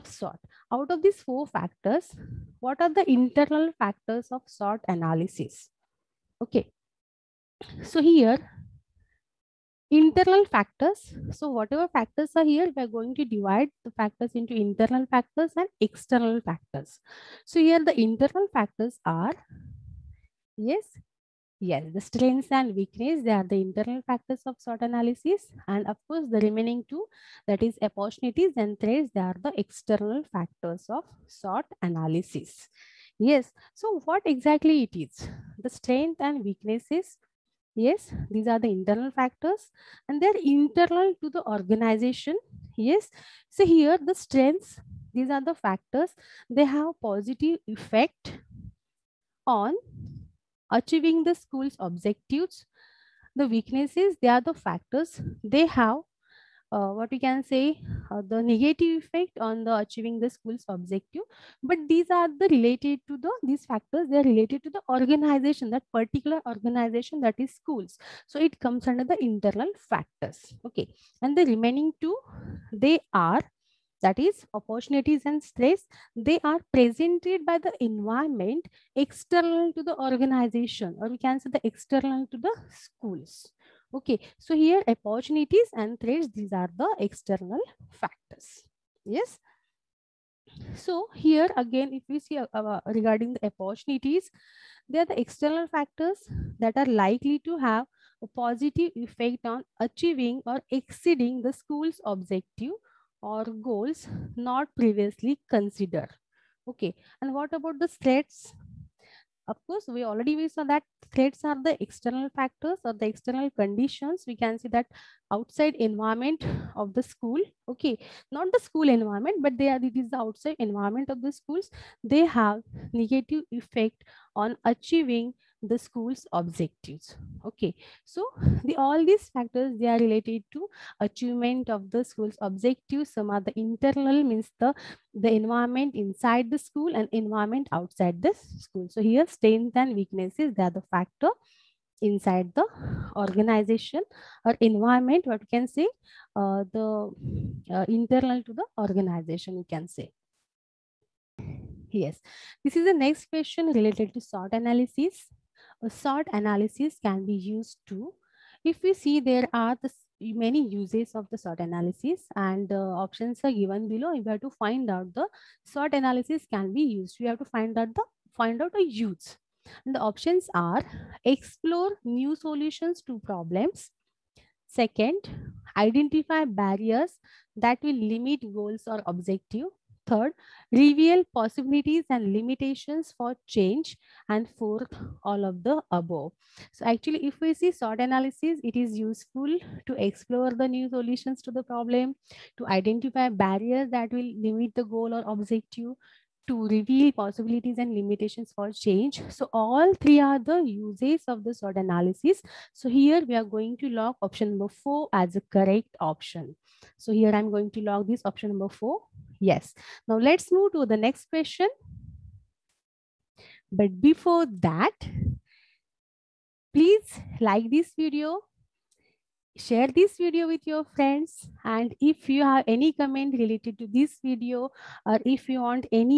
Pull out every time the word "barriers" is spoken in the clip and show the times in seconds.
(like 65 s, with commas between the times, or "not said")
176 s, 193 s.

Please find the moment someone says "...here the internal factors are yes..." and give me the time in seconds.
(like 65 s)
17 s.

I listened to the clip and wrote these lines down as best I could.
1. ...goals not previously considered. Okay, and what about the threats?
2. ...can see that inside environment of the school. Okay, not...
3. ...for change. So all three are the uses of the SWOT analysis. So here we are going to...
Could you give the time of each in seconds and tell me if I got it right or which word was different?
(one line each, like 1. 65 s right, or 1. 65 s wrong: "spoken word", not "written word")
1. 103 s right
2. 114 s wrong: "outside", not "inside"
3. 198 s right.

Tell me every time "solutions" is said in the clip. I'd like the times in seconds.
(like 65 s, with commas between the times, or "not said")
172 s, 190 s.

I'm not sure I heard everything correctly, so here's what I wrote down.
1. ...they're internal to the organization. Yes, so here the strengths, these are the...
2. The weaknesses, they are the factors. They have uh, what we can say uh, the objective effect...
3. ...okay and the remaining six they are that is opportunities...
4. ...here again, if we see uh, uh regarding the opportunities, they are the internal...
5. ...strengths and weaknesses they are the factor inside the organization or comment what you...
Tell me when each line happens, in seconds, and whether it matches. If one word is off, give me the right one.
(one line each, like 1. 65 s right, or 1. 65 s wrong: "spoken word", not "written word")
1. 40 s right
2. 53 s wrong: "negative", not "objective"
3. 70 s wrong: "two", not "six"
4. 91 s wrong: "external", not "internal"
5. 139 s wrong: "environment", not "comment".